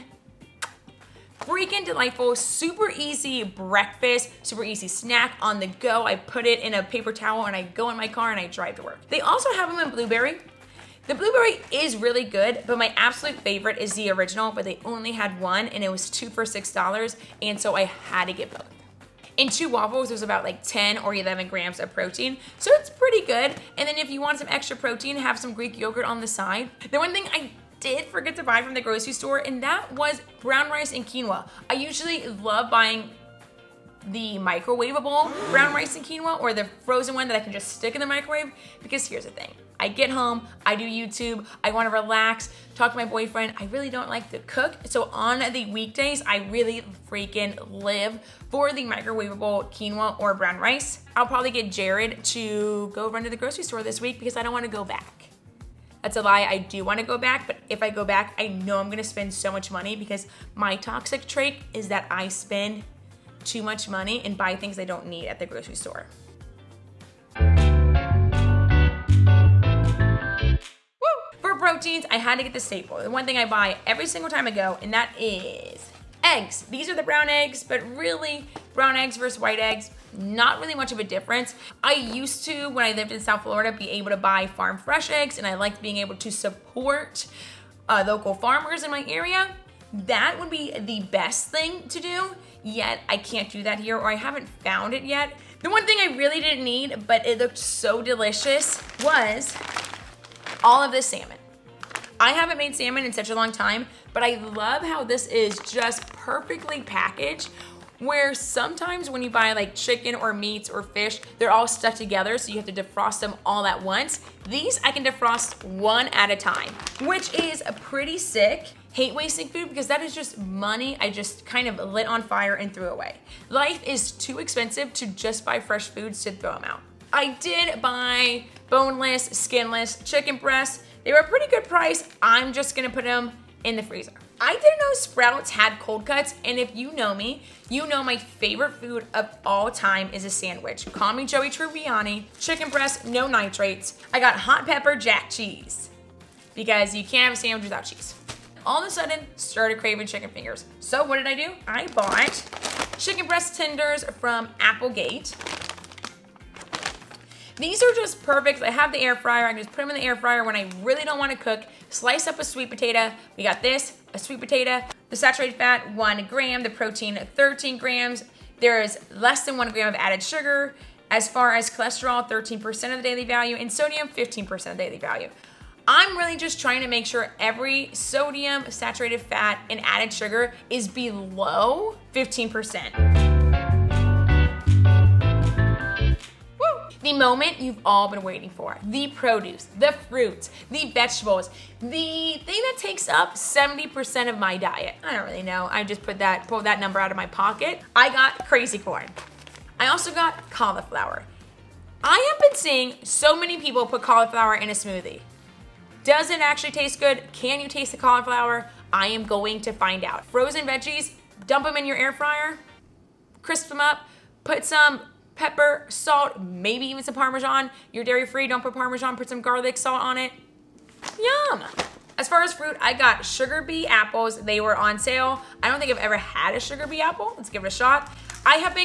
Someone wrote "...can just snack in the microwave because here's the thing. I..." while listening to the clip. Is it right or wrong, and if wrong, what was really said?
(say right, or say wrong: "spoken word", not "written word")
wrong: "stick", not "snack".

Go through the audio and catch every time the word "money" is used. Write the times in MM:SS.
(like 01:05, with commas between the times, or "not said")
00:59, 01:03, 02:00.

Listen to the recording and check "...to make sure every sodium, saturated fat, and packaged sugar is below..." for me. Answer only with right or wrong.
wrong.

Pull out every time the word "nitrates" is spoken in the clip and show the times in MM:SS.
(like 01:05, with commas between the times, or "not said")
02:23.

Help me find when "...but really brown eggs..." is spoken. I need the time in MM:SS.
01:17.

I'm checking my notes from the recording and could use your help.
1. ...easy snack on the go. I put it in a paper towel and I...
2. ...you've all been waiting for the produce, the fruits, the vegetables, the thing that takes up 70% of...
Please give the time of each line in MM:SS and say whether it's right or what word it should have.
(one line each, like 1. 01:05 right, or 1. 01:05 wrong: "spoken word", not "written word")
1. 00:04 right
2. 03:07 right.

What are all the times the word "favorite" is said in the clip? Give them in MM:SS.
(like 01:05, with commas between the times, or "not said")
00:13, 02:18.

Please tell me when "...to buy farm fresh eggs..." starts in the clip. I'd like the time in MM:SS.
01:24.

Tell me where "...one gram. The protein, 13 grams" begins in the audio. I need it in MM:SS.
02:45.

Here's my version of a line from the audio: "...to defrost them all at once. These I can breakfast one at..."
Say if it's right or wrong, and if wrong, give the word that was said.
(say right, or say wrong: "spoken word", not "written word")
wrong: "defrost", not "breakfast".